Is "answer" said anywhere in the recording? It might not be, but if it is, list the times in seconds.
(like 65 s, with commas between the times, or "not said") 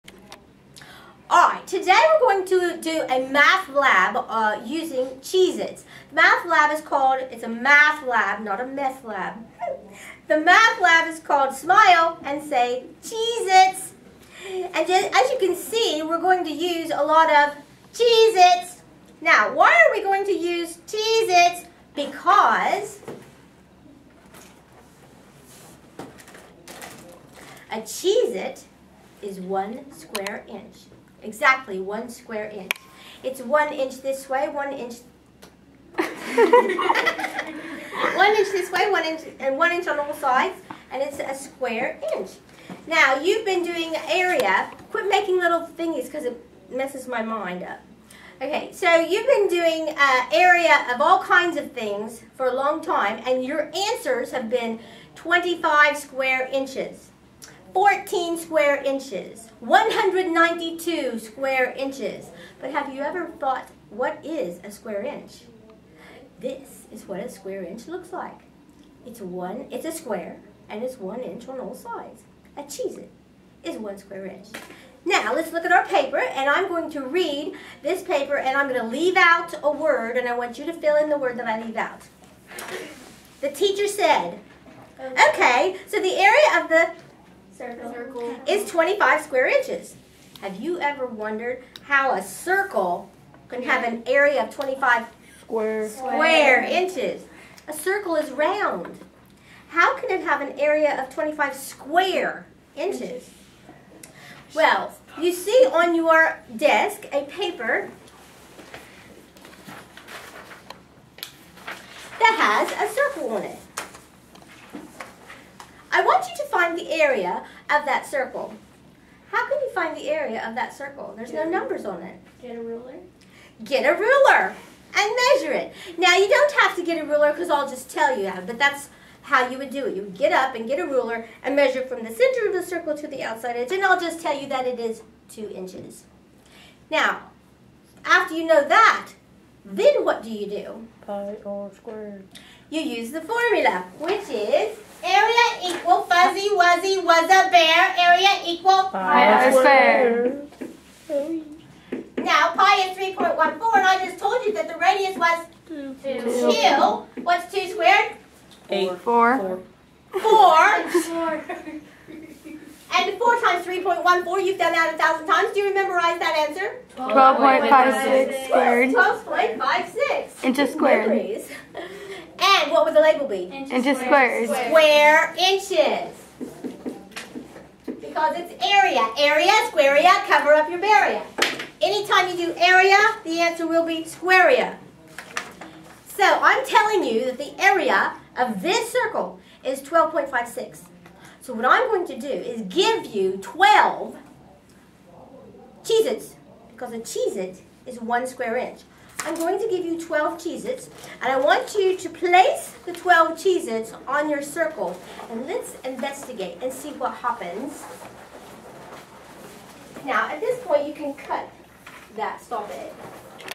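53 s, 166 s, 183 s.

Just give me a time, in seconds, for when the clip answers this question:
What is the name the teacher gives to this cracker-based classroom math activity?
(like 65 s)
11 s.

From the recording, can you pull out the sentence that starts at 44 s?
Quit making little thingies because it messes my mind up.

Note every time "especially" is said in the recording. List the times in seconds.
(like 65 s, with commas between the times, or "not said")
not said.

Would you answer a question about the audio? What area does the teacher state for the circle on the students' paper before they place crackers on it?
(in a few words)
12.56.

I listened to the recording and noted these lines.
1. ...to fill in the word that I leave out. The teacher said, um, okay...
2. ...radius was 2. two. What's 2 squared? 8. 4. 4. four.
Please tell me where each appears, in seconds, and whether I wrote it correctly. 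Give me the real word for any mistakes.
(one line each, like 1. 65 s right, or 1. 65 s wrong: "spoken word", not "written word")
1. 80 s right
2. 154 s right.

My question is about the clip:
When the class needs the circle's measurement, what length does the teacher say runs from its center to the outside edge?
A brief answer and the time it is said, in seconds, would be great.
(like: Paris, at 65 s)
2 inches, at 134 s.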